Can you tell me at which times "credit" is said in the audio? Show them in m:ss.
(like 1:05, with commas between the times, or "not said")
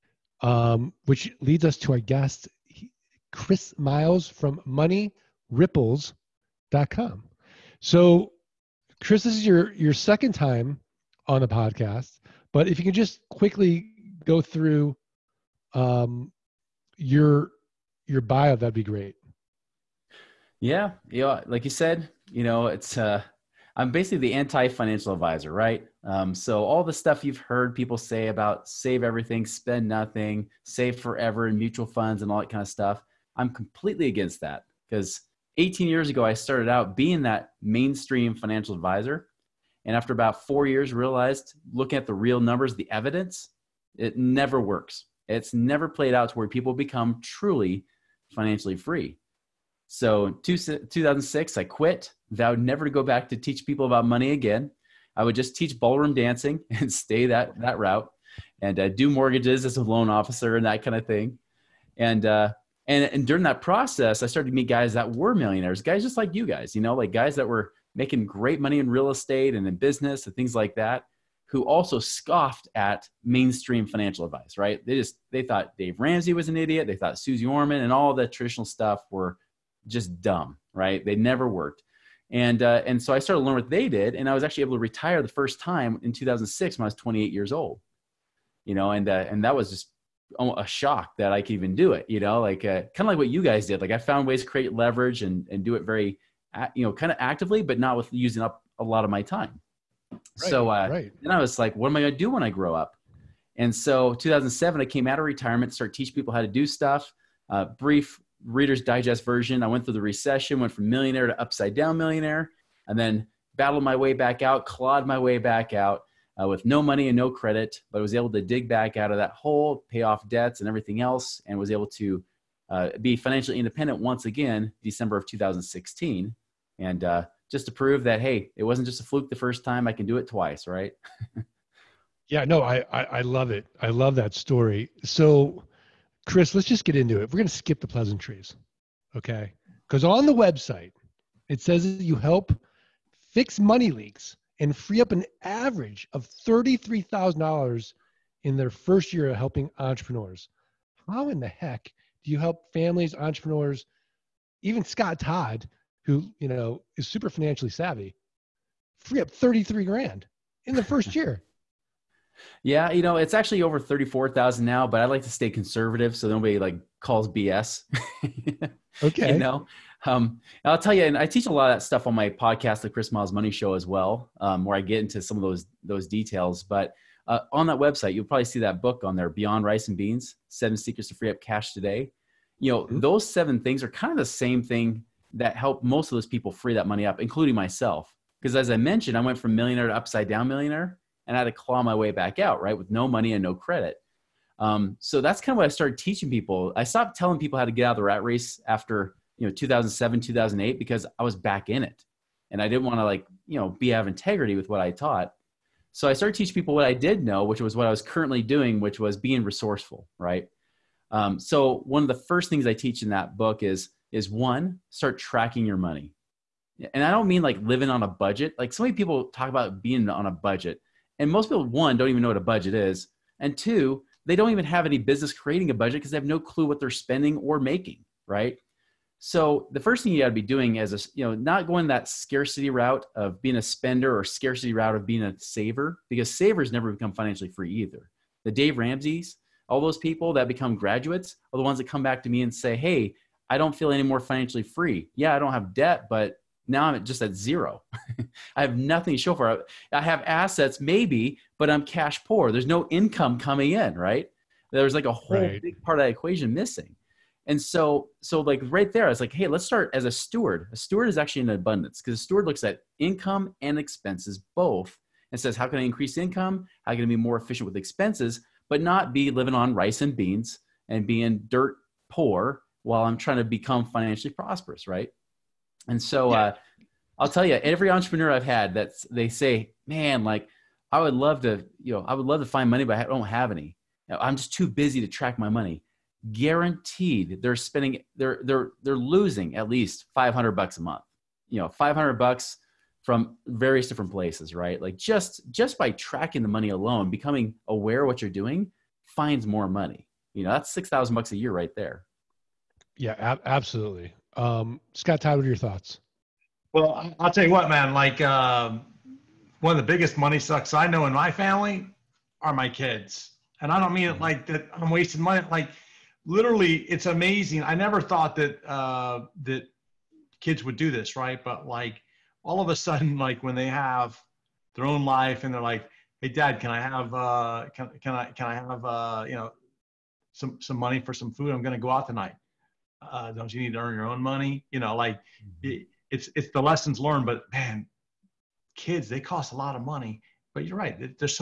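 1:57, 3:13.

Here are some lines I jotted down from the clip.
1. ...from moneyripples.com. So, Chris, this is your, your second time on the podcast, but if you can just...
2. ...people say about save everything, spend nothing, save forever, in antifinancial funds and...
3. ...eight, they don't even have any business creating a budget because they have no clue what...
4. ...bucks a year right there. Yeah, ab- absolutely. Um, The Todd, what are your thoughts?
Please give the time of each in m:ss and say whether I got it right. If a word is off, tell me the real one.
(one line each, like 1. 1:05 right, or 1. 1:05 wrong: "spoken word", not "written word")
1. 0:04 right
2. 0:27 wrong: "mutual", not "antifinancial"
3. 3:43 wrong: "two", not "eight"
4. 5:01 wrong: "Scott", not "The".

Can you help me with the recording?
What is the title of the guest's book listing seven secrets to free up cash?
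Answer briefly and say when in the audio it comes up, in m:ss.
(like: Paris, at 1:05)
Beyond Rice and Beans, at 2:59.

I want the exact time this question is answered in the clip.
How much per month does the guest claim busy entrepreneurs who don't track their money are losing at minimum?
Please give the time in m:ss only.
4:50.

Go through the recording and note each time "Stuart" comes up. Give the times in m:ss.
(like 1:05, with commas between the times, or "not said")
not said.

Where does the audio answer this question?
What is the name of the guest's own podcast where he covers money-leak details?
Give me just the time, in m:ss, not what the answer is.
2:52.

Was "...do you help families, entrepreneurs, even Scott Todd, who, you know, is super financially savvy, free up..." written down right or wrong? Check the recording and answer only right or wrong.
right.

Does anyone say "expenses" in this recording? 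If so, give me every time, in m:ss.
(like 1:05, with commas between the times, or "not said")
4:23, 4:27.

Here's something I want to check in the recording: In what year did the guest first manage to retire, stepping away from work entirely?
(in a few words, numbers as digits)
2006.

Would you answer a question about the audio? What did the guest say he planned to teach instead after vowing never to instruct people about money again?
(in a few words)
ballroom dancing.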